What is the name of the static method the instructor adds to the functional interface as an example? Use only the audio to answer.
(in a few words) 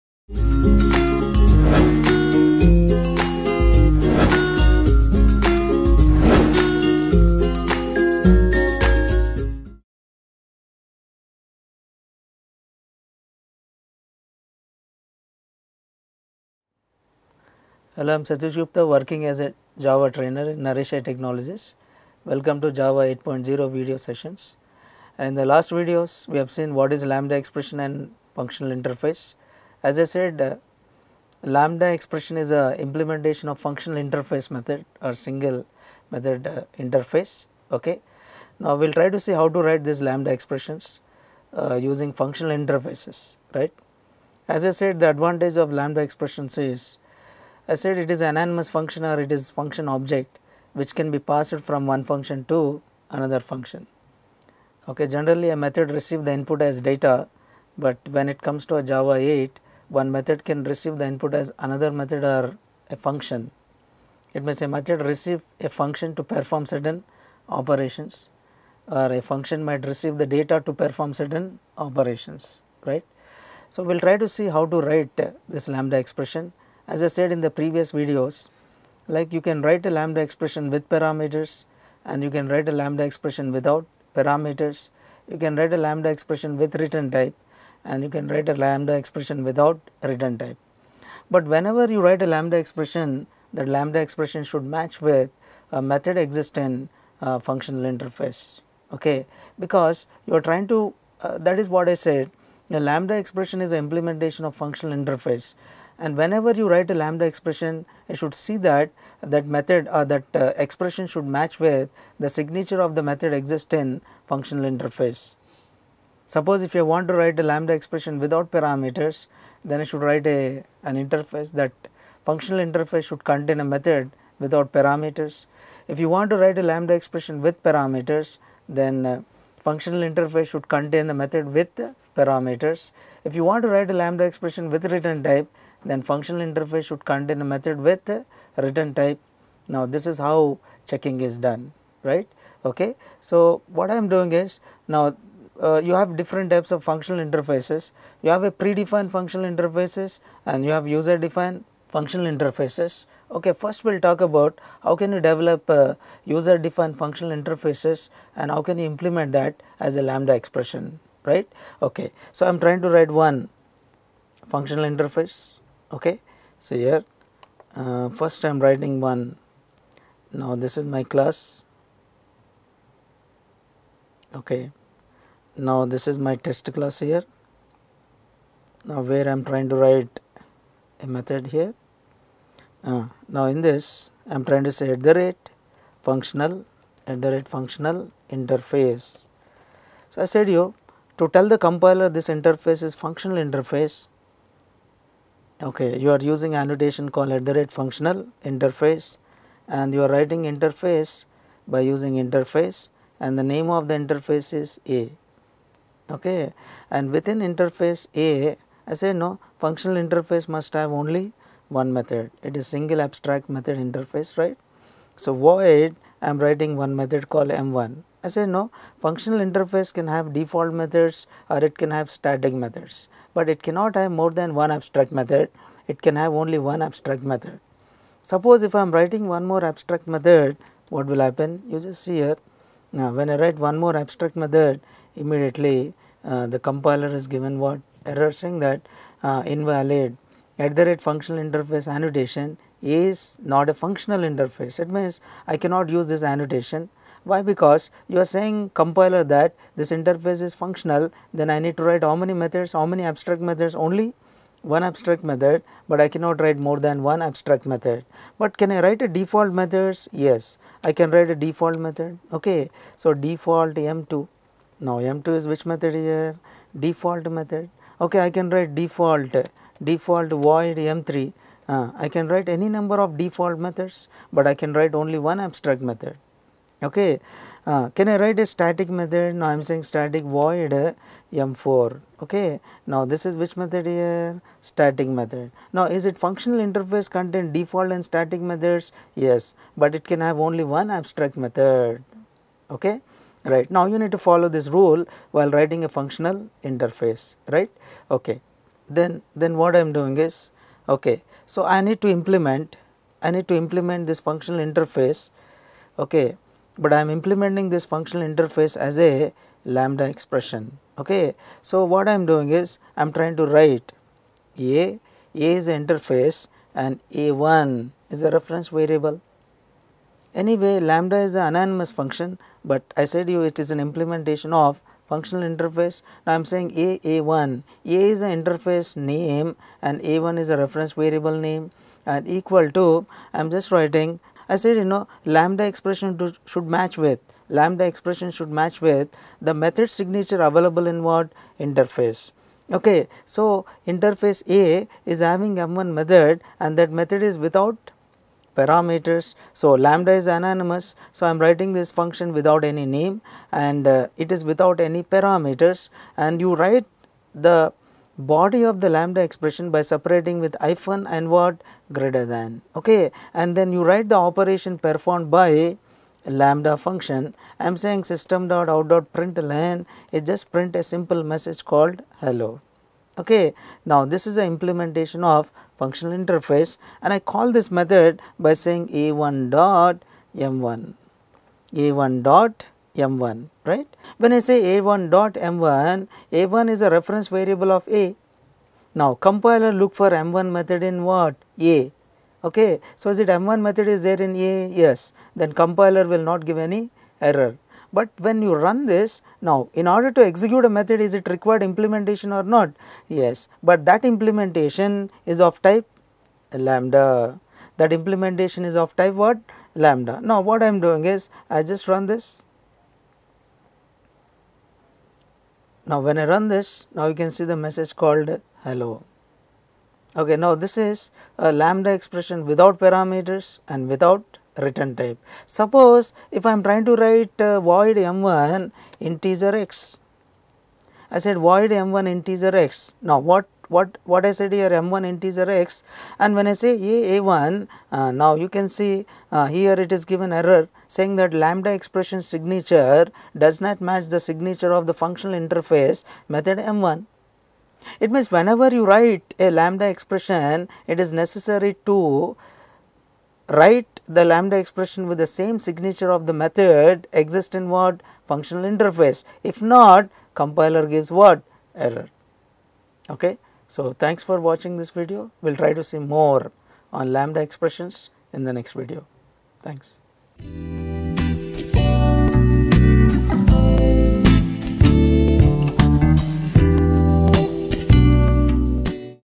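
M4.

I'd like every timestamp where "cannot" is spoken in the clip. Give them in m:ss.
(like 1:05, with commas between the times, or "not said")
3:43, 4:05, 4:16.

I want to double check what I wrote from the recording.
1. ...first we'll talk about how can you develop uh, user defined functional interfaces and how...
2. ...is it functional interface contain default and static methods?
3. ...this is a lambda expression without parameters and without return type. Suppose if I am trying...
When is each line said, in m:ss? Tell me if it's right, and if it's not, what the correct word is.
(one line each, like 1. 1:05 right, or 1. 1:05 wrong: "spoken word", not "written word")
1. 2:33 right
2. 4:45 right
3. 7:00 right.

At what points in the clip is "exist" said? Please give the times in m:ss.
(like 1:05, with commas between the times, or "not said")
1:36, 1:53, 7:37.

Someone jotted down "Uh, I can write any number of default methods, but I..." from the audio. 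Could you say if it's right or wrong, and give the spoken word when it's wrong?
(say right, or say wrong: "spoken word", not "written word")
right.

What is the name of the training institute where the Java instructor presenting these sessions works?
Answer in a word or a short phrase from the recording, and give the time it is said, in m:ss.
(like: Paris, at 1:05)
Naresh i Technologies, at 0:20.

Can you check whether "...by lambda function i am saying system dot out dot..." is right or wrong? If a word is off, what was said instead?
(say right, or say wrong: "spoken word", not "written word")
right.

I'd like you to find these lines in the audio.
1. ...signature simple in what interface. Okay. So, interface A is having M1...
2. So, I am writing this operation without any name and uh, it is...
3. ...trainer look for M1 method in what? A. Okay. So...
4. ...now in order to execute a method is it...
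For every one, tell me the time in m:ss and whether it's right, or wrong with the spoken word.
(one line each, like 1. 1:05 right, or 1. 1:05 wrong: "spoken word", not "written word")
1. 5:39 wrong: "available", not "simple"
2. 5:51 wrong: "function", not "operation"
3. 6:29 wrong: "compiler", not "trainer"
4. 6:39 right.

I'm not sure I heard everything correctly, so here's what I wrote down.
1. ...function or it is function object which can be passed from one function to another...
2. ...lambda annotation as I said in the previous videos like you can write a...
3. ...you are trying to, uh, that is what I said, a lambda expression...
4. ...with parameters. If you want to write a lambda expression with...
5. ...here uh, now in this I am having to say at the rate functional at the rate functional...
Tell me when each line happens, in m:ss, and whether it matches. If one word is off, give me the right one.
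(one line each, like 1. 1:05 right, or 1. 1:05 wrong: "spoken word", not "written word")
1. 0:48 right
2. 1:15 wrong: "expression", not "annotation"
3. 1:40 right
4. 2:11 right
5. 3:01 wrong: "trying", not "having".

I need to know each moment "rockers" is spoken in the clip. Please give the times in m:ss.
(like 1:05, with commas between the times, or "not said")
not said.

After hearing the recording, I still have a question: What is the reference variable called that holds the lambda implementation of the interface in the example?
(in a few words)
A1.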